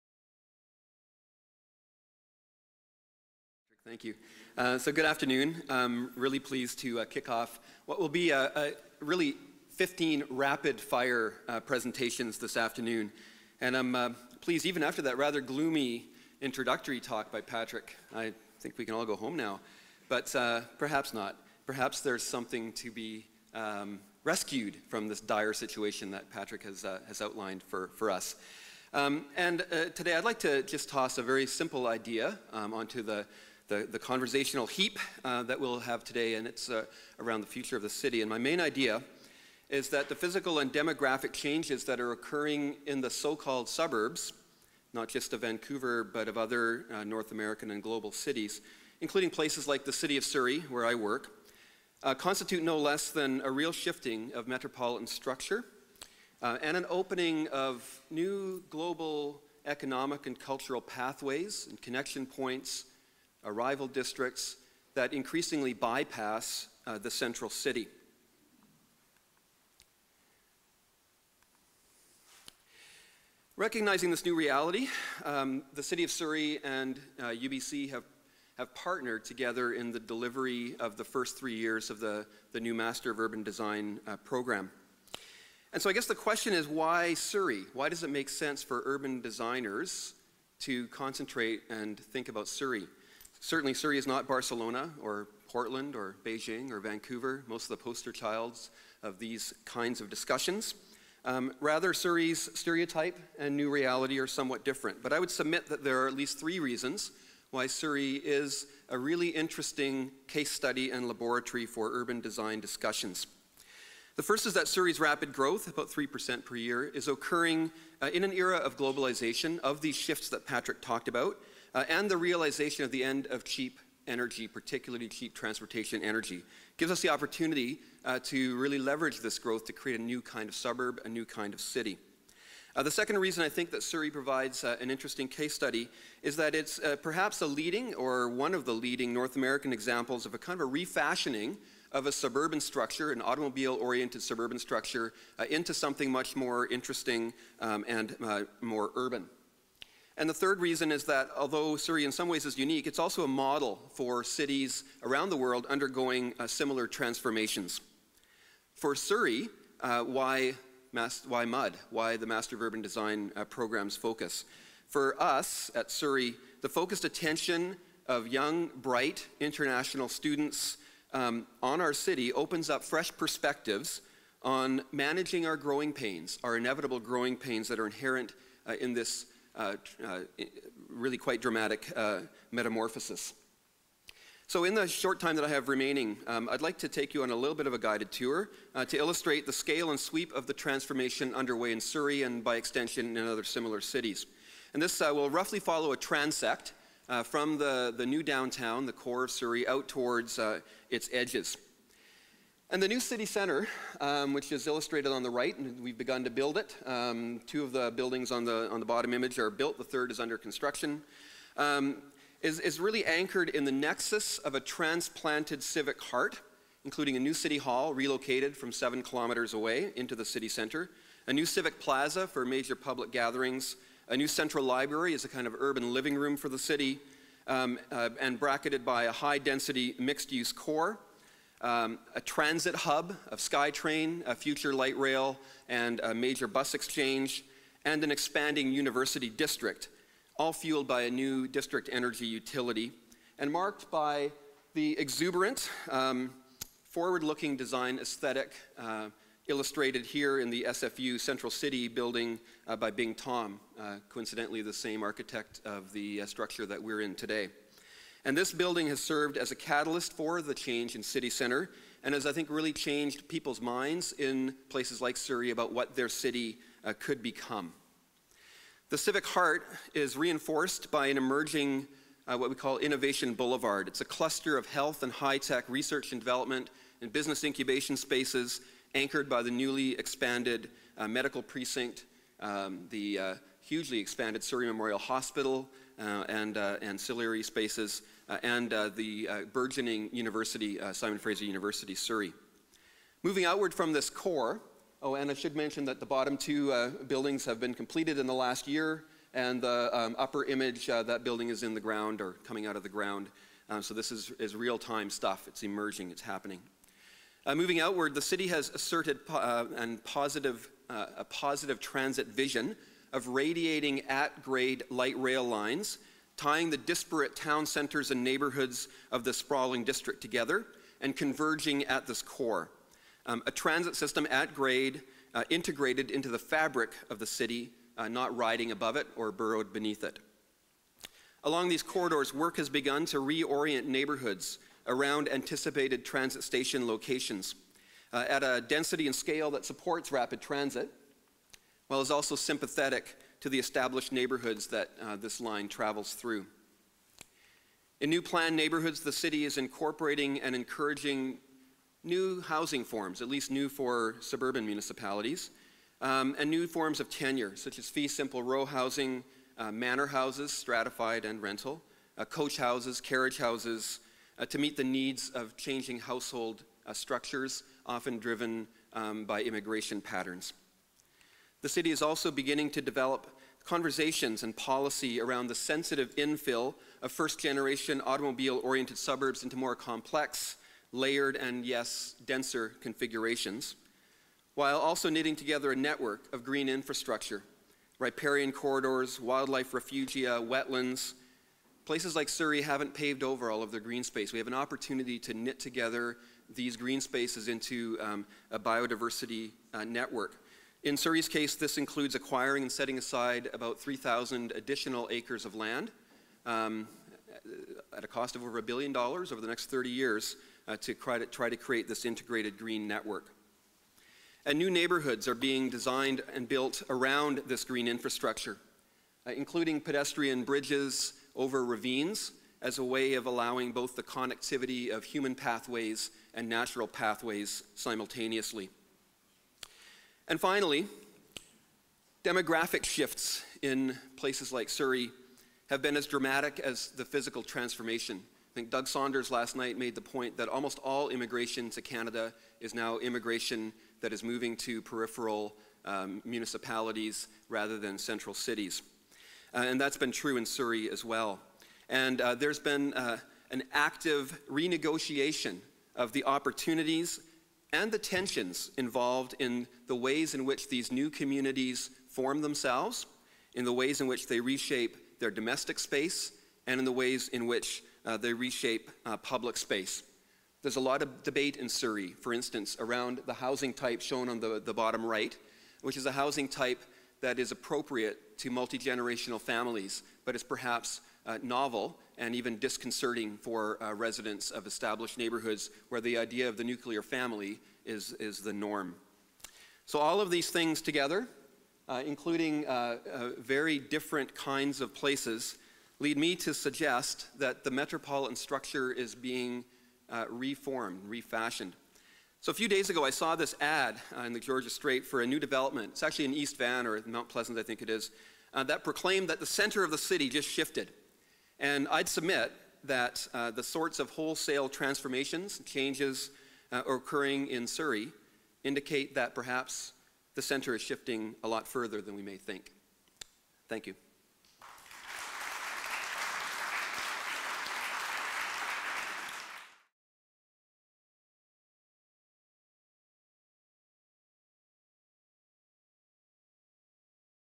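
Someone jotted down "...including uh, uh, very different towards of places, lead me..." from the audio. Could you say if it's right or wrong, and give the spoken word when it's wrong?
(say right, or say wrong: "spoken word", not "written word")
wrong: "kinds", not "towards".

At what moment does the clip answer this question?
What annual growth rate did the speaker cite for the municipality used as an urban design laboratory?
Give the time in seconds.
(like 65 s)
115 s.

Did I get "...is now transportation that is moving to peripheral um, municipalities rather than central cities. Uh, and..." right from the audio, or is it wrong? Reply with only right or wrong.
wrong.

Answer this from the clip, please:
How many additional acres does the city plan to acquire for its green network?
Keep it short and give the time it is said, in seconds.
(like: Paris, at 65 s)
3,000 acres, at 403 s.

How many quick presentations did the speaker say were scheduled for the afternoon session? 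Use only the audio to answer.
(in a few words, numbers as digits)
15.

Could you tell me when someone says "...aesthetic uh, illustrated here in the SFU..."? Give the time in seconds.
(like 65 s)
247 s.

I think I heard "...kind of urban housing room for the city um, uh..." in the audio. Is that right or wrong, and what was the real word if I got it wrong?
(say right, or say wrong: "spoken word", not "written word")
wrong: "living", not "housing".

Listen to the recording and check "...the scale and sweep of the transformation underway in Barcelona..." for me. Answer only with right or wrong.
wrong.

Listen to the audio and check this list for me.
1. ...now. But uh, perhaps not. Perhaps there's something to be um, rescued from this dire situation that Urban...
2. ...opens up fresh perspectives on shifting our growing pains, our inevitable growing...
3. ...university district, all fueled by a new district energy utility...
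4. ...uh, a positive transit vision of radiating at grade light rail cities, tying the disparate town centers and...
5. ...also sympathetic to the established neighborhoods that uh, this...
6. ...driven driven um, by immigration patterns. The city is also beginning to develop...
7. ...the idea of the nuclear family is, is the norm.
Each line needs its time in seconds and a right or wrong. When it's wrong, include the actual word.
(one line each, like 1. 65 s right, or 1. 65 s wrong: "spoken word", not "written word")
1. 19 s wrong: "Patrick", not "Urban"
2. 172 s wrong: "managing", not "shifting"
3. 238 s right
4. 310 s wrong: "lines", not "cities"
5. 342 s right
6. 367 s wrong: "often", not "driven"
7. 486 s right.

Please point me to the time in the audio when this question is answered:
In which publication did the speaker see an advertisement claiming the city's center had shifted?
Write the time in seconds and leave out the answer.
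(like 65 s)
504 s.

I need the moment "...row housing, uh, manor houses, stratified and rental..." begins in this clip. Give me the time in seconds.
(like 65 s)
358 s.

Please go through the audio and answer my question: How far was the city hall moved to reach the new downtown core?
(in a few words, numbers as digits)
7 kilometres.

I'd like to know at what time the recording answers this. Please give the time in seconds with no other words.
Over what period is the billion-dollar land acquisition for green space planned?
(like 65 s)
409 s.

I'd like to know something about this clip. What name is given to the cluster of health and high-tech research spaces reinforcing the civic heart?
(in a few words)
Innovation Boulevard.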